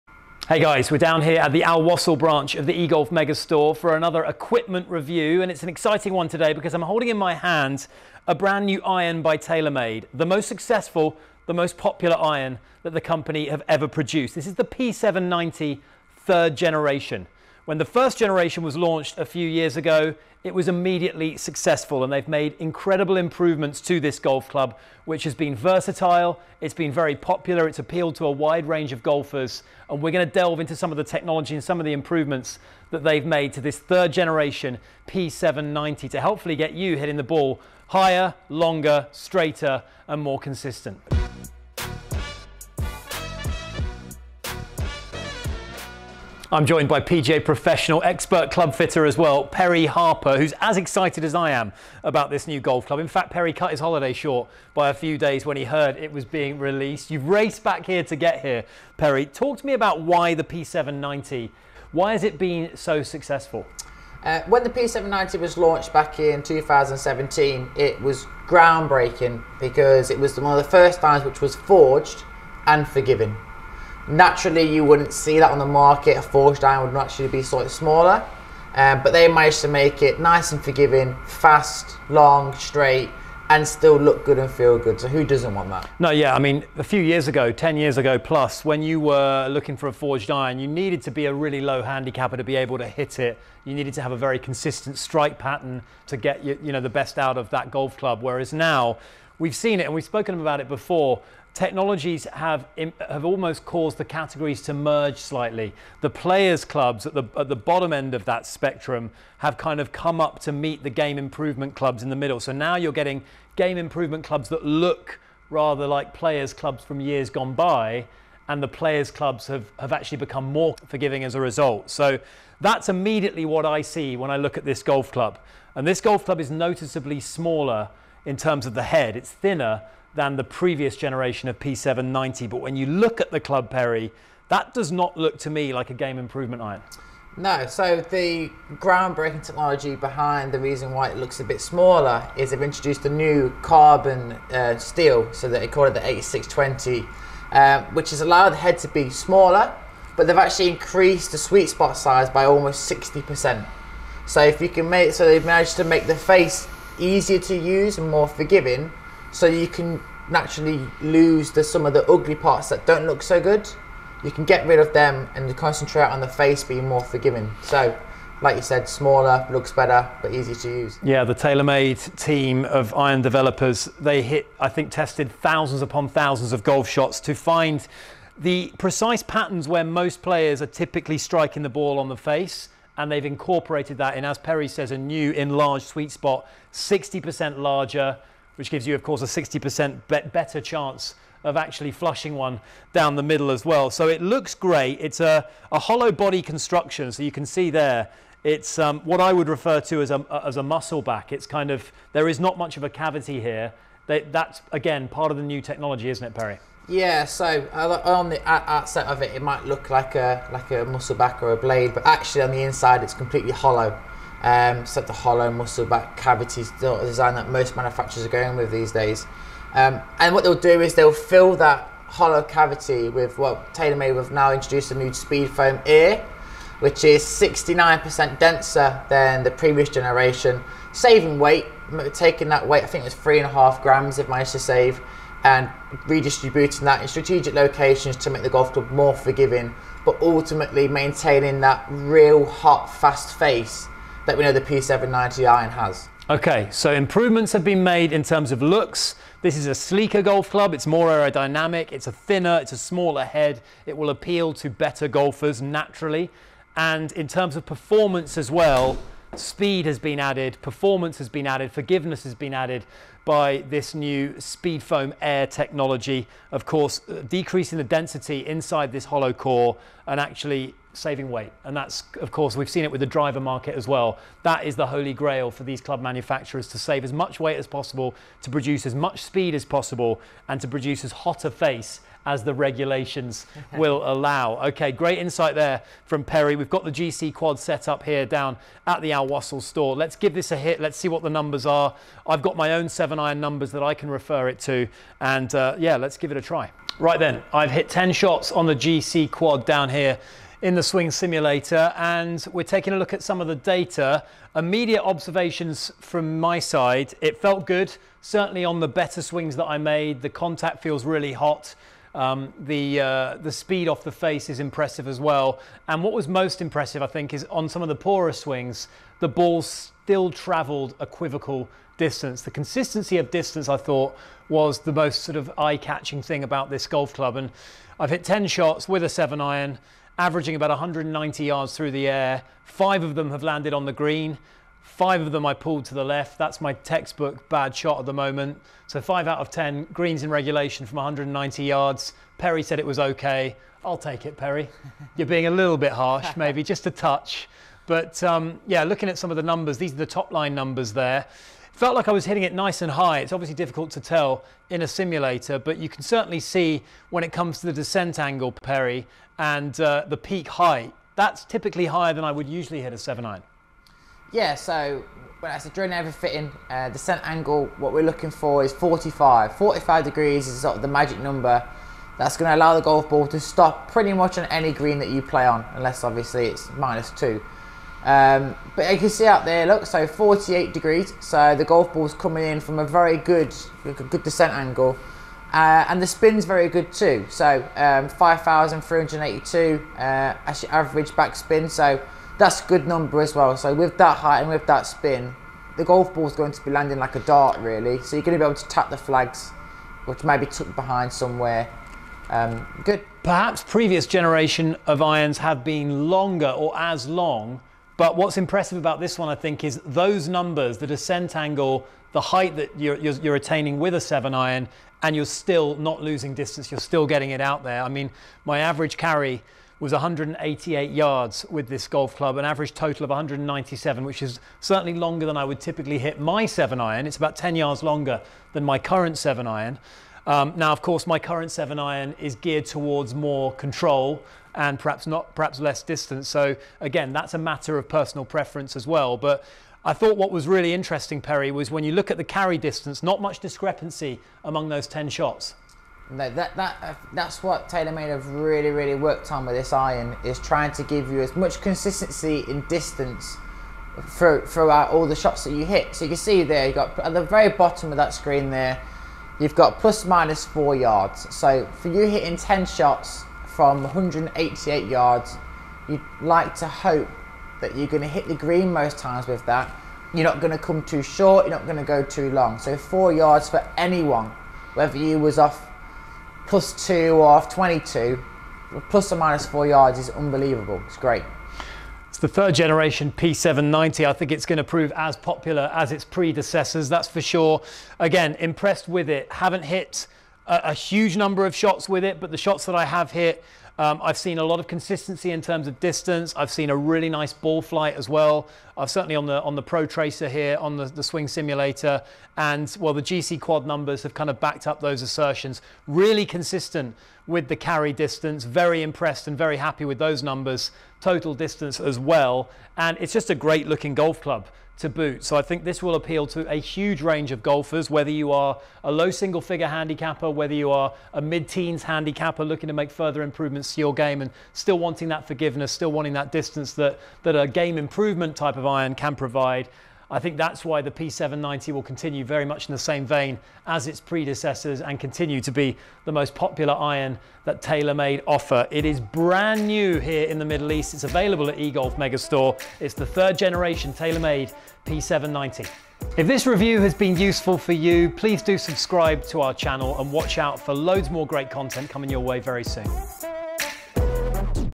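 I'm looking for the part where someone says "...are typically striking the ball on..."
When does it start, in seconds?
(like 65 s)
180 s.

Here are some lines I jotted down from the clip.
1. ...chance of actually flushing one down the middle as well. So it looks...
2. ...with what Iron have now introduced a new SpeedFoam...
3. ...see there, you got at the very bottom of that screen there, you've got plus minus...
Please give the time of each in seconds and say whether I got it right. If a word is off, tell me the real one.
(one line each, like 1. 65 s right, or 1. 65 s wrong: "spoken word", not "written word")
1. 190 s right
2. 223 s wrong: "TaylorMade", not "Iron"
3. 456 s right.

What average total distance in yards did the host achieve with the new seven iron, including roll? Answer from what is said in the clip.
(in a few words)
197 yards.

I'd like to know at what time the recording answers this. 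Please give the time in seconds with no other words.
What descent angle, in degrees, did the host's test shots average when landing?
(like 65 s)
380 s.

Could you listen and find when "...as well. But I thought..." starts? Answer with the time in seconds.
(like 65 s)
438 s.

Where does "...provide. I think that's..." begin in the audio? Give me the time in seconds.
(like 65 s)
529 s.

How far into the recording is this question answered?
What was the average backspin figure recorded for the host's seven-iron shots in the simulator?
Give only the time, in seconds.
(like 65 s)
388 s.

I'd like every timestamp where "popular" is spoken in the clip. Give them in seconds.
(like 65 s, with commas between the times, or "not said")
11 s, 27 s, 485 s, 536 s.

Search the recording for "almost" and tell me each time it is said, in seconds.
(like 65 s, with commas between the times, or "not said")
103 s, 152 s.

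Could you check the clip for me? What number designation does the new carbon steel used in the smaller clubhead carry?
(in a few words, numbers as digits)
8620.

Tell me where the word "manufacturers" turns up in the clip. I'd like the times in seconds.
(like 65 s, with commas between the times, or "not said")
217 s, 276 s.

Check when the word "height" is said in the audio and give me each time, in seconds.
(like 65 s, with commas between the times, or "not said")
360 s, 394 s, 412 s.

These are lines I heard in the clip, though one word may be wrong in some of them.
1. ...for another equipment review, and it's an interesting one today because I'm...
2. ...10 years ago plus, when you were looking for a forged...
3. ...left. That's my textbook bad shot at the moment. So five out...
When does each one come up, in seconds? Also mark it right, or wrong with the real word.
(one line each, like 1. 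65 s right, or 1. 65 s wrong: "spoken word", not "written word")
1. 3 s wrong: "exciting", not "interesting"
2. 87 s right
3. 336 s right.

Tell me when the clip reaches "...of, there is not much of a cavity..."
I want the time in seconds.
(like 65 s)
201 s.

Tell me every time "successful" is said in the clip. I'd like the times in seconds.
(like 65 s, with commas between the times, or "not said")
10 s, 21 s, 63 s.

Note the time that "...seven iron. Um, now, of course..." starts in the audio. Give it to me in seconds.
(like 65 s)
429 s.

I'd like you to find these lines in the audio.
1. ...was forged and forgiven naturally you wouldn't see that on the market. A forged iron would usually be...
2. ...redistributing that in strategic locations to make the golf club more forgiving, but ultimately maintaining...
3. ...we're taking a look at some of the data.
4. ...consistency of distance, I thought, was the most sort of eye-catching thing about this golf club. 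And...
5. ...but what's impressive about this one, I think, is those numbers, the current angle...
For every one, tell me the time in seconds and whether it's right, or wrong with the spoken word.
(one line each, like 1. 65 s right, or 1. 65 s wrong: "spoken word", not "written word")
1. 71 s wrong: "naturally", not "usually"
2. 236 s right
3. 302 s right
4. 322 s right
5. 408 s wrong: "descent", not "current".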